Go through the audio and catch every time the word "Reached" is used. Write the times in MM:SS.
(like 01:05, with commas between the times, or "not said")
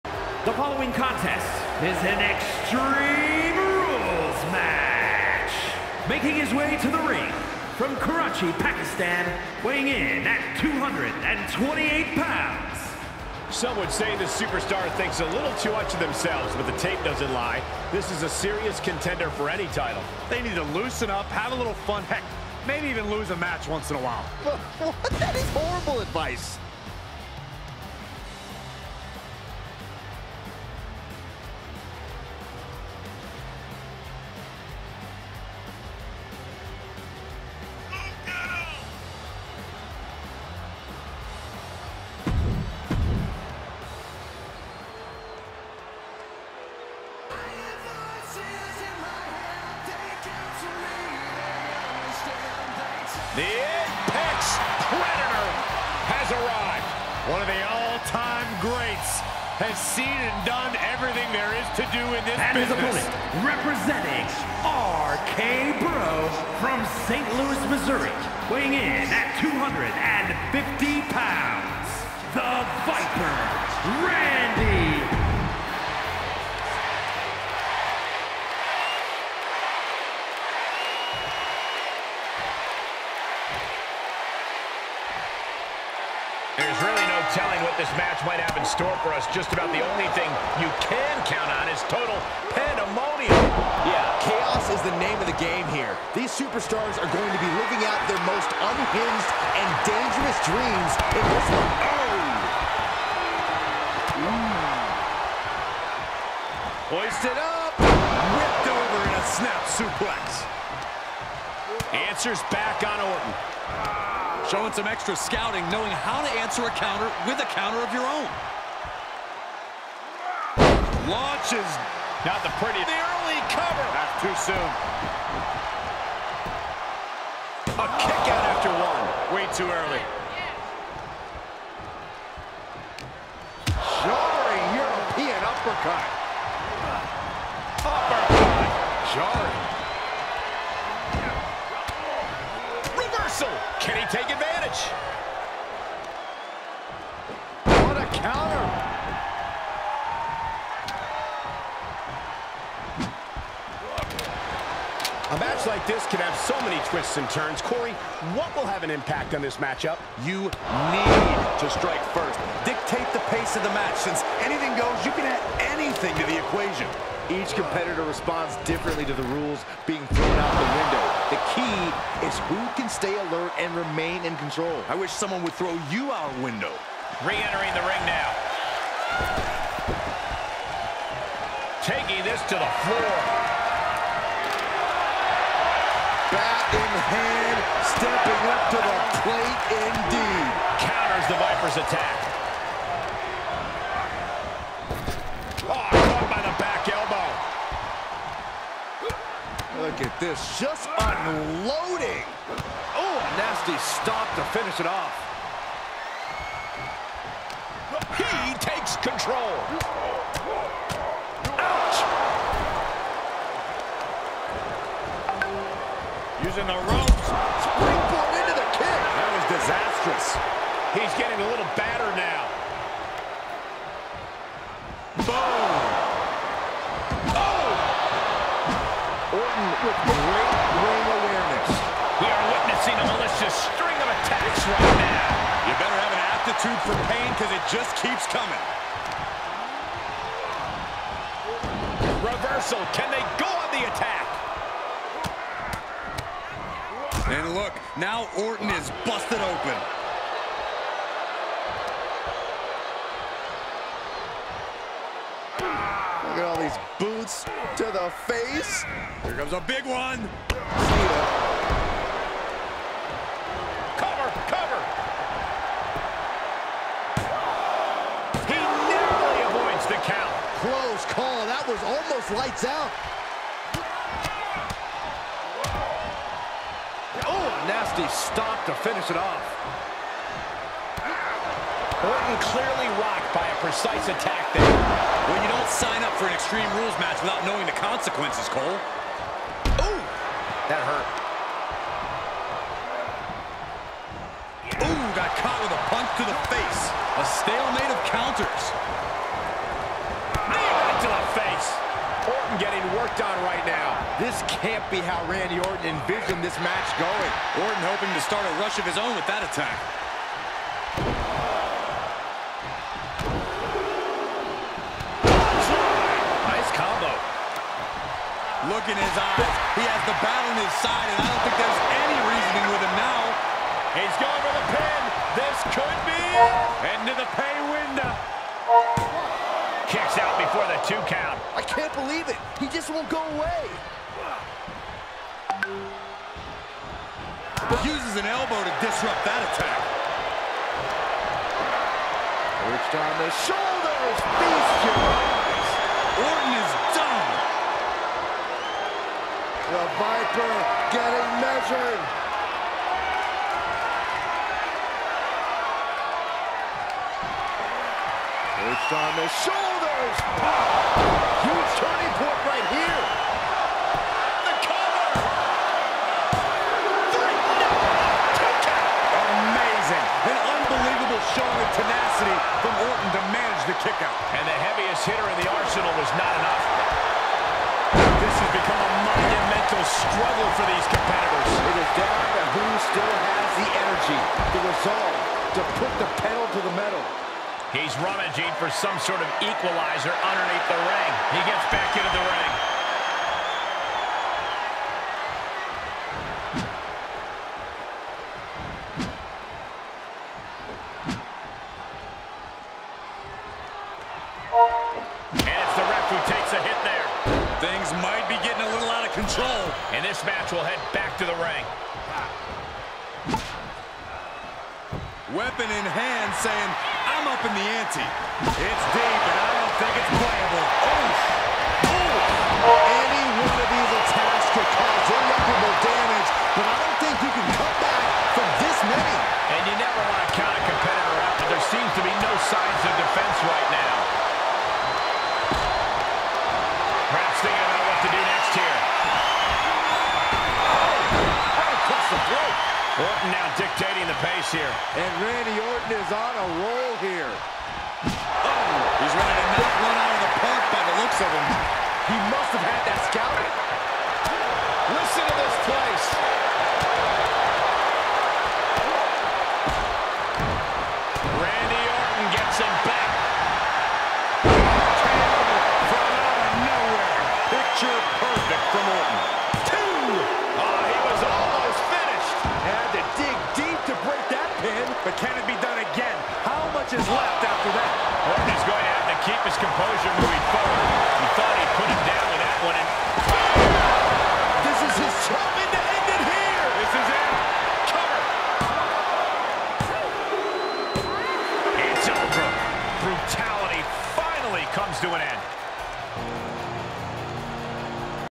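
05:42, 05:58.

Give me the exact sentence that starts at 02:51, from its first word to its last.
The who can stay alert and remain in control?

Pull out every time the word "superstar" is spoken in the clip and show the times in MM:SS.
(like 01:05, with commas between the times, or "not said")
00:14, 01:36.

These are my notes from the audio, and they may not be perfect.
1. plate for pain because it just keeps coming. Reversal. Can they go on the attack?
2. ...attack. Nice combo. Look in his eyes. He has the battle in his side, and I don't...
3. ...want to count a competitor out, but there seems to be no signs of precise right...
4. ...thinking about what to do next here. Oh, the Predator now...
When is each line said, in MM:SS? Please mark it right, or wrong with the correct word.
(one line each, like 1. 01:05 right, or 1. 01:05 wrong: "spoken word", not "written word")
1. 03:56 wrong: "substitute", not "plate"
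2. 05:09 right
3. 07:10 wrong: "defense", not "precise"
4. 07:17 wrong: "Orton", not "Predator".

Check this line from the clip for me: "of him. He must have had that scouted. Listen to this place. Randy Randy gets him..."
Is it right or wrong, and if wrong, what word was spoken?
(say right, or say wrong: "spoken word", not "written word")
wrong: "Orton", not "Randy".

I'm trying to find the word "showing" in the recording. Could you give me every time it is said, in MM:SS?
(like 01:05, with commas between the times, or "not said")
01:54, 06:11.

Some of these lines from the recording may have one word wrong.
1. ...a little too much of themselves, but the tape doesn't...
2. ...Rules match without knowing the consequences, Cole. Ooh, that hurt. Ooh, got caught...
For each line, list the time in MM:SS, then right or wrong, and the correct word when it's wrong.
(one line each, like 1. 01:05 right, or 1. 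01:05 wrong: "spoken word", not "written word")
1. 00:15 right
2. 04:46 right.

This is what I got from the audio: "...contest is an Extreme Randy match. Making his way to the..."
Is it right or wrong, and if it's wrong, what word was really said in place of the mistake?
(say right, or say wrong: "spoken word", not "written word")
wrong: "Rules", not "Randy".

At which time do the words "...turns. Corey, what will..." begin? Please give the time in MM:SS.
02:37.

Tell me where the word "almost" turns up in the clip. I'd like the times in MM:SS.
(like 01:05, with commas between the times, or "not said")
04:31, 07:51.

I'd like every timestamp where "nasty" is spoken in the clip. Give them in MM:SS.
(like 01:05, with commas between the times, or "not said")
03:23, 04:37.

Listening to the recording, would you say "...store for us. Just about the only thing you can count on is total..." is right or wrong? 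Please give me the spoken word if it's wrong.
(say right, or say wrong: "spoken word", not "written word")
right.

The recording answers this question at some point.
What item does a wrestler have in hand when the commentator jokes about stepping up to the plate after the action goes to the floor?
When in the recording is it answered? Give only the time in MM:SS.
03:06.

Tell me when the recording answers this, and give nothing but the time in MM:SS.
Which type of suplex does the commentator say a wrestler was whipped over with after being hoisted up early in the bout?
01:49.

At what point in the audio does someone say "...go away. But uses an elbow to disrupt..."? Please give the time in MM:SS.
05:33.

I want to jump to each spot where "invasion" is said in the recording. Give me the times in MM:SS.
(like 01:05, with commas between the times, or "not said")
not said.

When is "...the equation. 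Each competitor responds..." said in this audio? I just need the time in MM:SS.
02:46.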